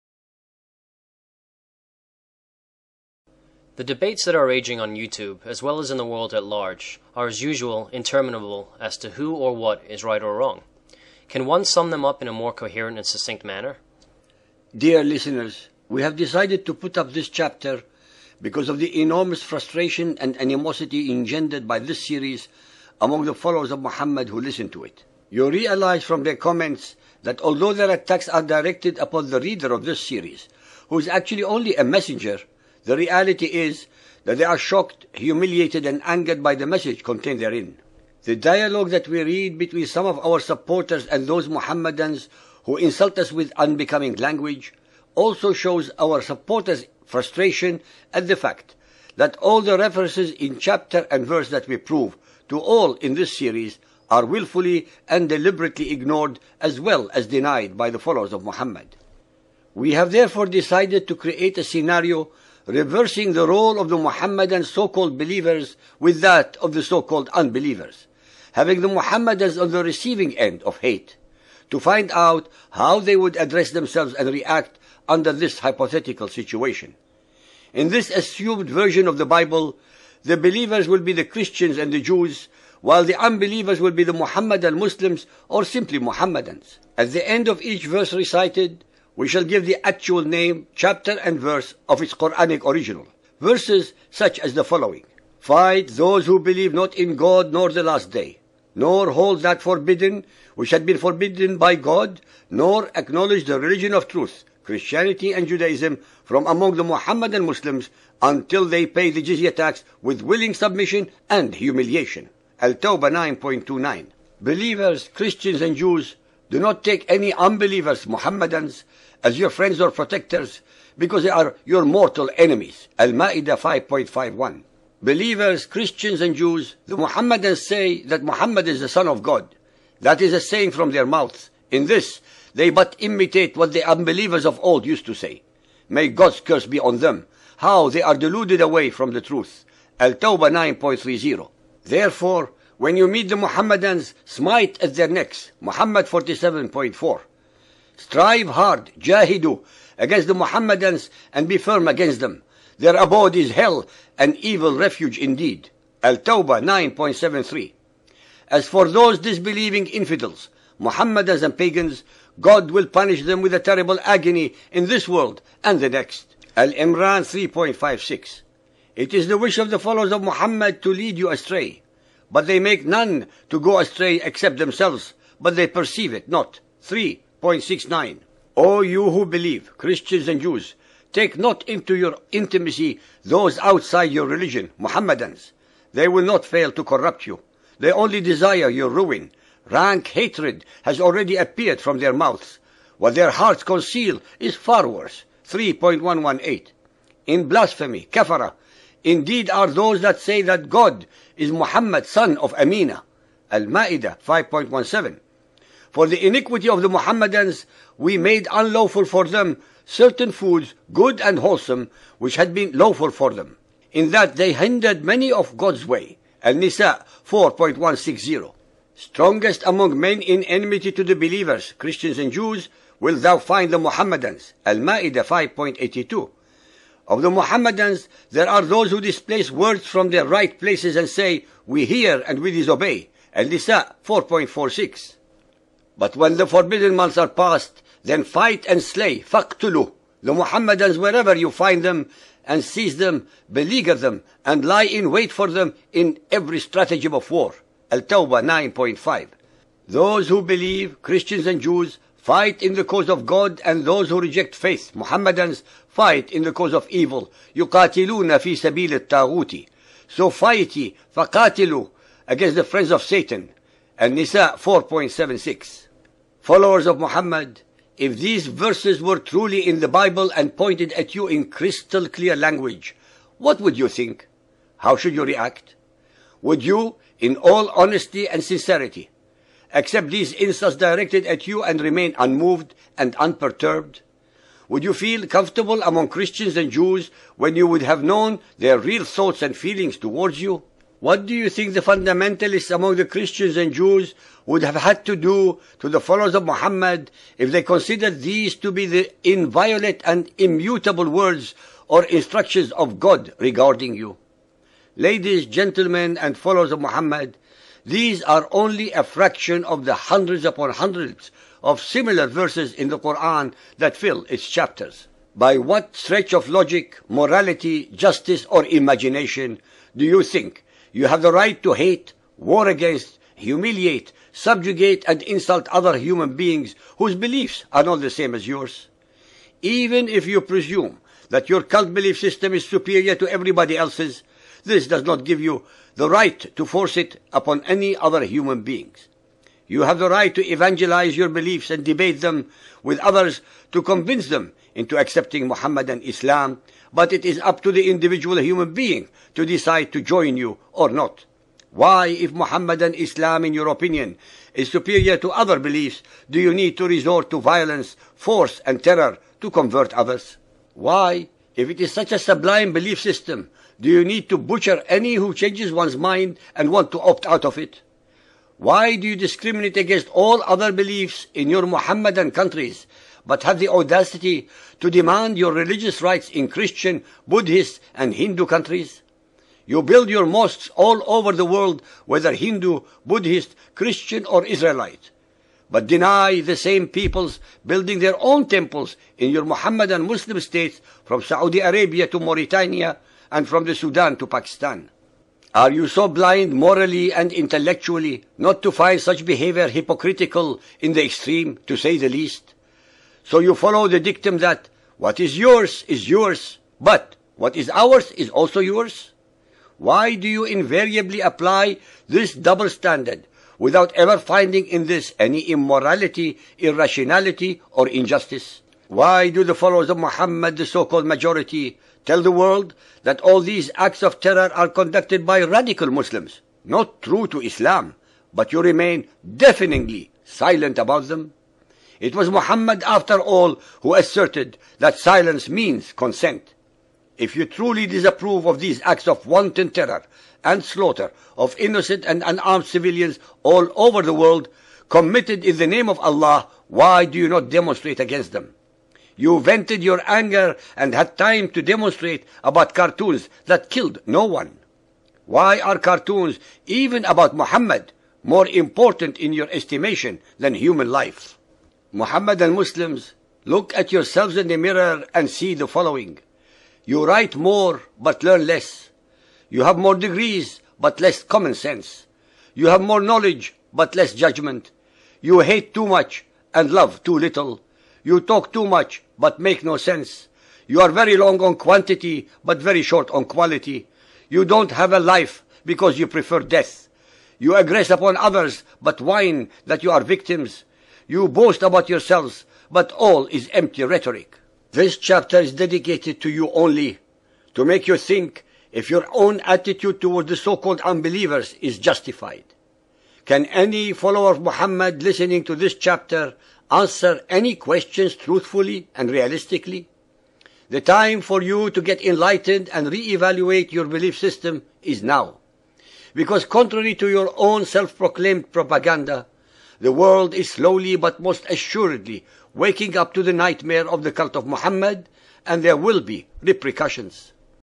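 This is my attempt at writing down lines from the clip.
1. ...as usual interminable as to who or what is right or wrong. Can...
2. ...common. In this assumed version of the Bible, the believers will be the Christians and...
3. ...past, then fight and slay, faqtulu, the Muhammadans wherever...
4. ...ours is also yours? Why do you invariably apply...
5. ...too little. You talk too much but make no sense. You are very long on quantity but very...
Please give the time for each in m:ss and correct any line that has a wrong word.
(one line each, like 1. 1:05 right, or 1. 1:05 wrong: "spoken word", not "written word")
1. 0:07 right
2. 1:16 wrong: "situation", not "common"
3. 3:57 right
4. 6:47 right
5. 7:57 right.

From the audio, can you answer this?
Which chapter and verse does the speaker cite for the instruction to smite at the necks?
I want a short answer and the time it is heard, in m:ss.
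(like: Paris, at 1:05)
Muhammad 47.4, at 2:25.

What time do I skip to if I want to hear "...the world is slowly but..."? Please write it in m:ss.
8:39.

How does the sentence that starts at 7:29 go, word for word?
You vented your anger and had time to demonstrate about cartoons that killed no one.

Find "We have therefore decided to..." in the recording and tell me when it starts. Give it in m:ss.
0:59.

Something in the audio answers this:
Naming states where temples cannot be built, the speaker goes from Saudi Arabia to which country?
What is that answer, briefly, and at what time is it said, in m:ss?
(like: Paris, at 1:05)
Mauritania, at 6:32.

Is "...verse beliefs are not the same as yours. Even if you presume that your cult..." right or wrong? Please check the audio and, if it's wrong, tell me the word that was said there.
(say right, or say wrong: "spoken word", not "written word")
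wrong: "whose", not "verse".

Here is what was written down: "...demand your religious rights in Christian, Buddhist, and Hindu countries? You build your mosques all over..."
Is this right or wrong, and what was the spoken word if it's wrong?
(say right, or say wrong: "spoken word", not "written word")
right.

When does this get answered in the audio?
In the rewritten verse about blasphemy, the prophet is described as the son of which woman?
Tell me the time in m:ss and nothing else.
3:22.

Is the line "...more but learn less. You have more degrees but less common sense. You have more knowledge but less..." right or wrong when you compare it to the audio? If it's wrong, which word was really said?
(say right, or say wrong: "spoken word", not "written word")
right.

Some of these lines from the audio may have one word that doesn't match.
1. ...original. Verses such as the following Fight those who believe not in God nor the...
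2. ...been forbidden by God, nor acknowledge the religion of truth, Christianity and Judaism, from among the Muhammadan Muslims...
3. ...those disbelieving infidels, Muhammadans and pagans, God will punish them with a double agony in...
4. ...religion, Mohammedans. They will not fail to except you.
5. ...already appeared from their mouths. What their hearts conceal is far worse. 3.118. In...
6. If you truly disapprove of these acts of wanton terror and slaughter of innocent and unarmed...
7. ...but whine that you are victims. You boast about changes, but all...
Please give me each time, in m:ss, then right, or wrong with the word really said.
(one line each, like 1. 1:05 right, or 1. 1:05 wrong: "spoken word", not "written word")
1. 1:32 right
2. 1:40 right
3. 2:38 wrong: "terrible", not "double"
4. 3:04 wrong: "corrupt", not "except"
5. 3:11 right
6. 7:17 right
7. 8:08 wrong: "yourselves", not "changes".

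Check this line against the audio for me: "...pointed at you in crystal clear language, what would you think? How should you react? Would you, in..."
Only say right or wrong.
right.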